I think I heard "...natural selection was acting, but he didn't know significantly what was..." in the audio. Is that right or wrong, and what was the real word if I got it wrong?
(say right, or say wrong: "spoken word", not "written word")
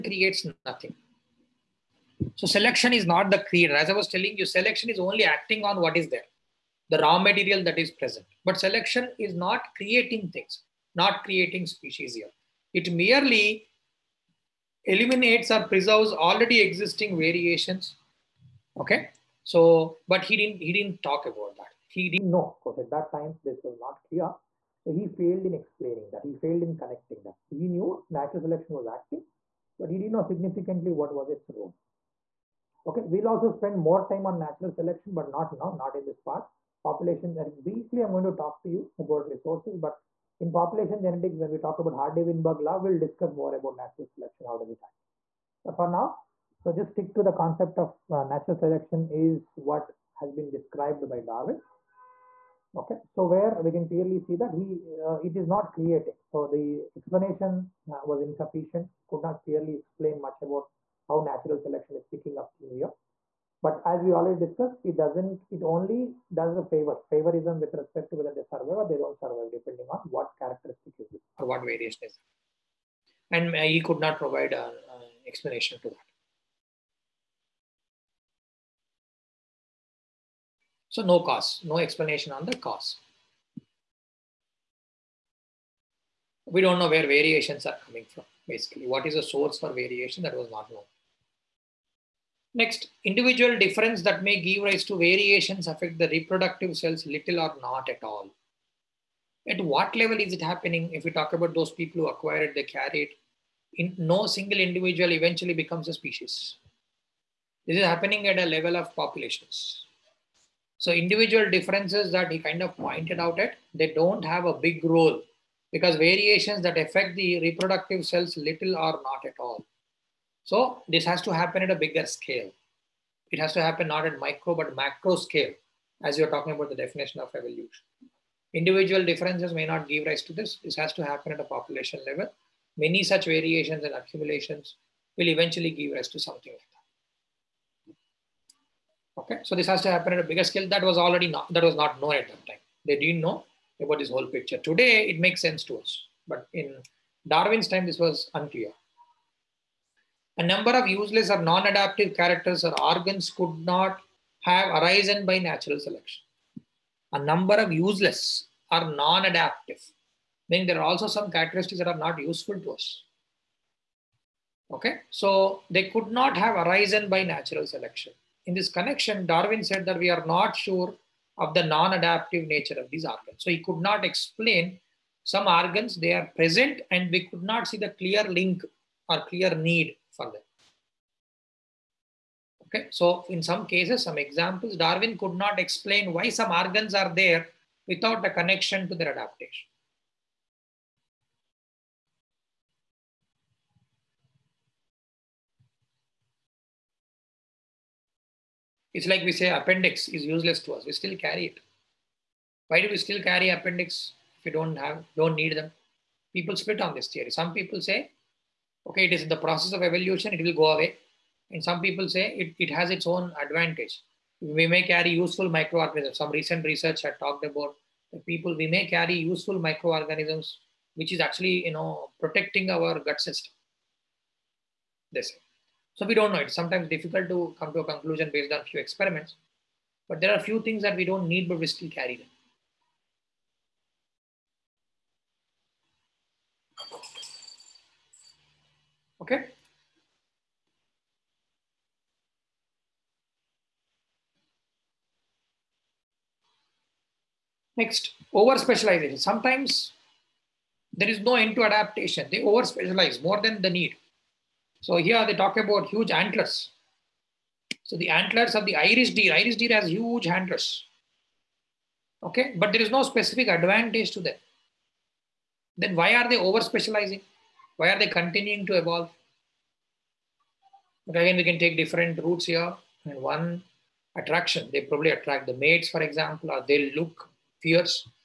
right.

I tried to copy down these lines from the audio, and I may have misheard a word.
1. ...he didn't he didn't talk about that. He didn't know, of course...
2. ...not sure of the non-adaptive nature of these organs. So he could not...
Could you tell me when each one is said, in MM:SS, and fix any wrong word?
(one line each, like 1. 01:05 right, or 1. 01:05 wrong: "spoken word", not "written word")
1. 00:20 right
2. 02:50 right.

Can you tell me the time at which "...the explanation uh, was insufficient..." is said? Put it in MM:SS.
00:56.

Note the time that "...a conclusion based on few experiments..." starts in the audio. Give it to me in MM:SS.
03:47.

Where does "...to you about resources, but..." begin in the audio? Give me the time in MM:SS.
00:38.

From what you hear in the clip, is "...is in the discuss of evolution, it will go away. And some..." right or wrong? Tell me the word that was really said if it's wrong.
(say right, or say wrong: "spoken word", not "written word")
wrong: "process", not "discuss".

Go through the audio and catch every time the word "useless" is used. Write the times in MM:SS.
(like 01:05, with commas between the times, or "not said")
02:30, 02:37, 03:20.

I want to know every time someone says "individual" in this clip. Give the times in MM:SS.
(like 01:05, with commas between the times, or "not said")
01:33, 01:44, 01:50, 02:08.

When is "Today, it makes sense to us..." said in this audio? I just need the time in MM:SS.
02:24.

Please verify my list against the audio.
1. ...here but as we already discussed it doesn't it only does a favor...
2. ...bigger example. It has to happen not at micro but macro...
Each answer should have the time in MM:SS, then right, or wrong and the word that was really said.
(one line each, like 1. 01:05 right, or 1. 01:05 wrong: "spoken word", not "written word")
1. 01:02 right
2. 02:01 wrong: "scale", not "example".